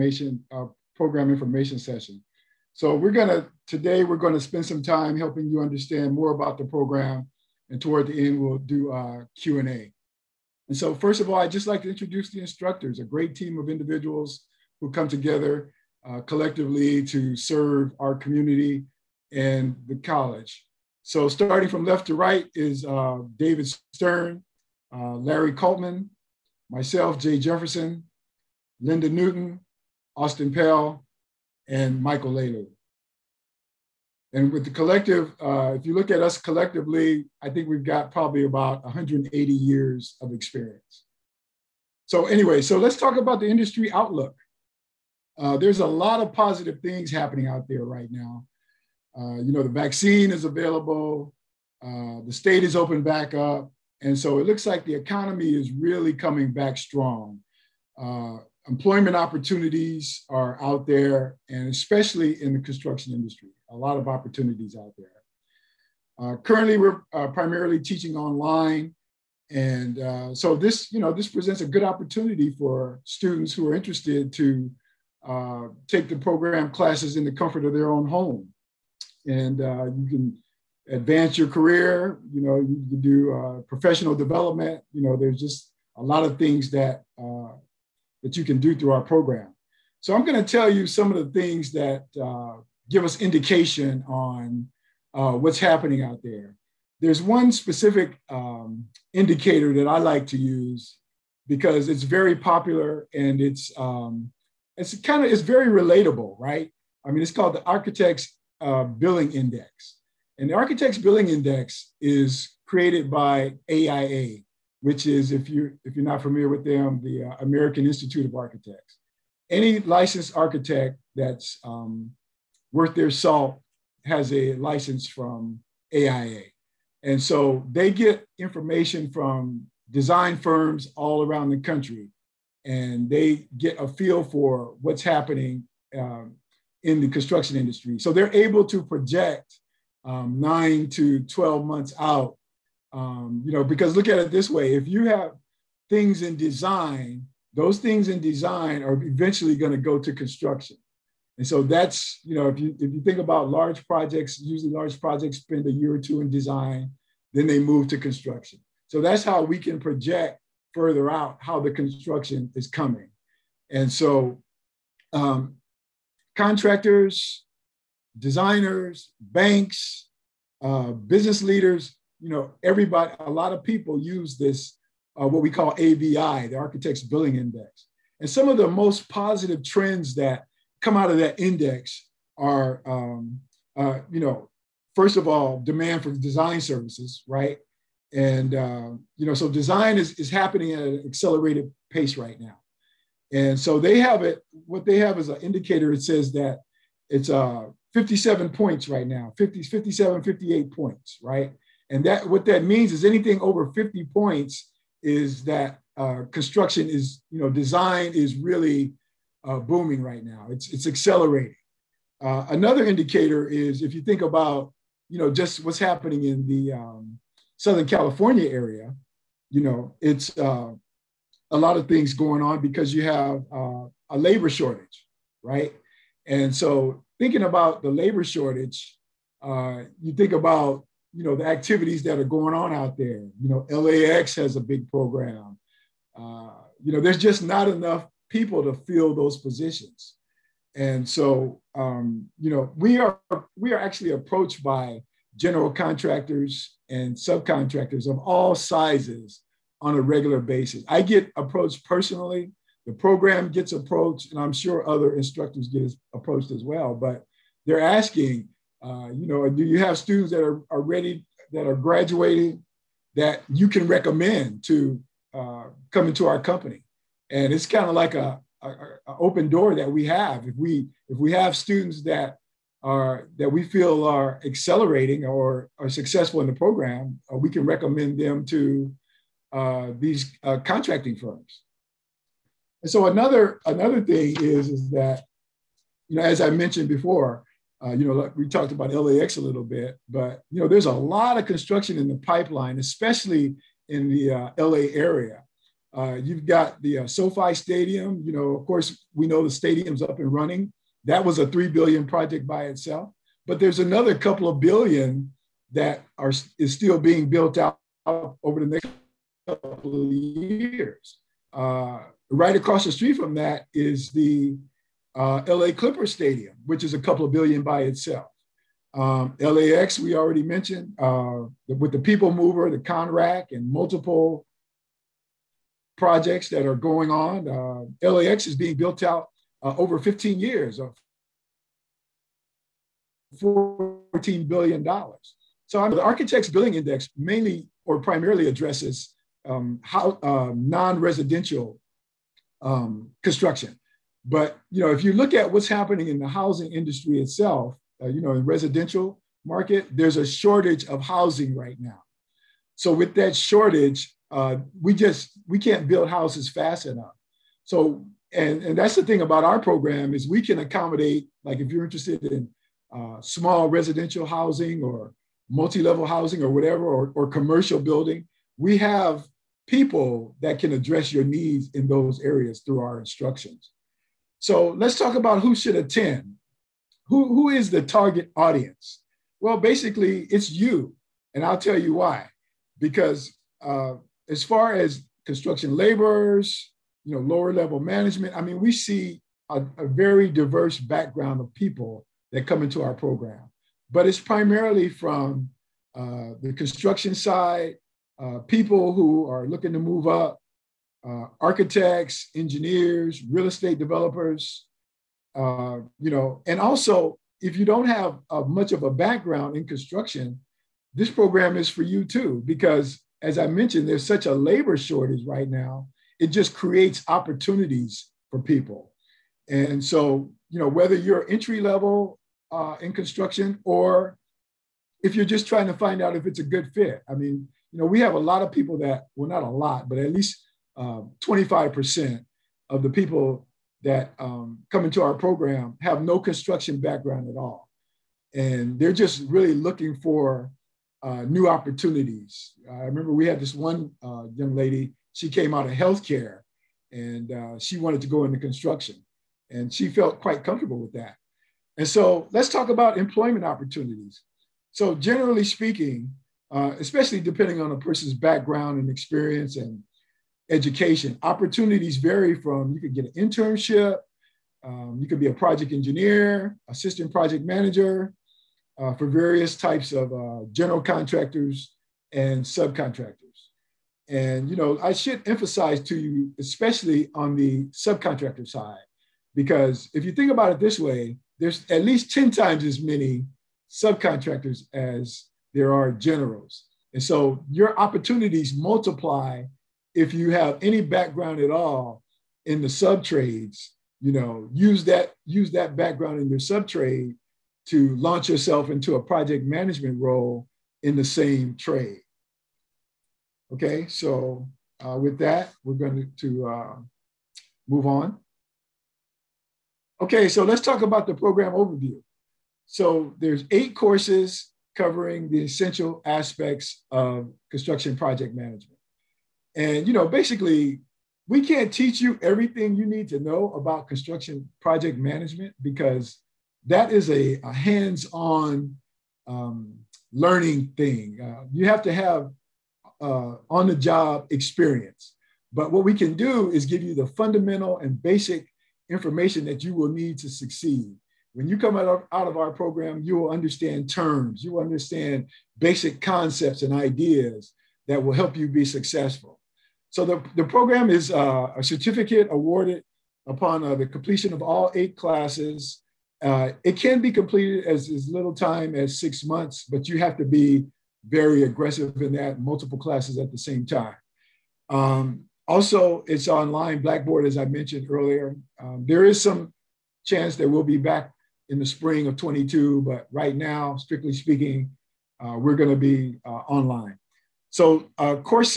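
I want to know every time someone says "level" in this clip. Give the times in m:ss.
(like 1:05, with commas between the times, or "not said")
6:05, 6:27, 7:01.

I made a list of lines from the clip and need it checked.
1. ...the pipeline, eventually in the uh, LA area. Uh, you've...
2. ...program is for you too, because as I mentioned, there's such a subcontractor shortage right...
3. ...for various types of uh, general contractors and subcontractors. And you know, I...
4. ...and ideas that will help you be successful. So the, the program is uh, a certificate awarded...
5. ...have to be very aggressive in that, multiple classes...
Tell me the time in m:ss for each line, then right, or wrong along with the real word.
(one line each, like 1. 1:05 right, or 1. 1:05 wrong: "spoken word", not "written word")
1. 4:52 wrong: "especially", not "eventually"
2. 6:51 wrong: "labor", not "subcontractor"
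3. 7:48 right
4. 9:06 right
5. 9:19 right.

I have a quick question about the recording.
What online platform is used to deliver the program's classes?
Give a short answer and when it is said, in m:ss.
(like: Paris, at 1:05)
Blackboard, at 9:26.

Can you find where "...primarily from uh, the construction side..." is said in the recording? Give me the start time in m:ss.
6:34.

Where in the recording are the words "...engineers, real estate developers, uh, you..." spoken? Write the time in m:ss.
6:42.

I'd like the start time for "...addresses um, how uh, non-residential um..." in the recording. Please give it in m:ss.
5:38.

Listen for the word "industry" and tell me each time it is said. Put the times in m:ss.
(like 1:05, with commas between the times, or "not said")
0:43, 1:03, 2:17, 5:46.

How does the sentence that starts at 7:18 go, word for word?
And they're just really looking for uh, new opportunities.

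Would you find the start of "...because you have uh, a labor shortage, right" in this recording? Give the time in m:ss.
3:42.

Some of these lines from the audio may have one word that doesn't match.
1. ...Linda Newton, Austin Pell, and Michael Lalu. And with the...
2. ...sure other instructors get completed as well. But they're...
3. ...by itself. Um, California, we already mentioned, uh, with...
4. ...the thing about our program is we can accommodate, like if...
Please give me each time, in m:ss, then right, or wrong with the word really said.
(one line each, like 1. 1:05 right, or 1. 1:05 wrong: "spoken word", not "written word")
1. 0:28 right
2. 4:14 wrong: "approached", not "completed"
3. 5:17 wrong: "LAX", not "California"
4. 5:58 right.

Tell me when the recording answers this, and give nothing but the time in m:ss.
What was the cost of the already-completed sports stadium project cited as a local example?
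5:01.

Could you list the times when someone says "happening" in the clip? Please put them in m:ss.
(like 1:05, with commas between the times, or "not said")
0:47, 1:35, 2:15, 3:10, 3:35, 5:45.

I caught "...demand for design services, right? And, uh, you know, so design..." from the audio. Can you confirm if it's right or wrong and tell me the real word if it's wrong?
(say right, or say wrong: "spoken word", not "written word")
right.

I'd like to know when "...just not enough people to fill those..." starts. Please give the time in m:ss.
3:57.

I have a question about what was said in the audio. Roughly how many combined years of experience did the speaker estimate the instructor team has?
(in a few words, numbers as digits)
180 years.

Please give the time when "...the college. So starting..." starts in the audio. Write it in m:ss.
0:19.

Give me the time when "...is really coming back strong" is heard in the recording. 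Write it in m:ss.
0:55.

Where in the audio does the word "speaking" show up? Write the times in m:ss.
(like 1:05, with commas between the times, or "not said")
7:35, 9:34.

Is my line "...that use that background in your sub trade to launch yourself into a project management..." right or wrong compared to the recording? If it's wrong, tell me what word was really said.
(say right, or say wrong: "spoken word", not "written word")
right.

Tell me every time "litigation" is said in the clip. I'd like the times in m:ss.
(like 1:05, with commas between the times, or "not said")
not said.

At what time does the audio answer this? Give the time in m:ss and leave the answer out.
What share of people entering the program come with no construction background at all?
7:10.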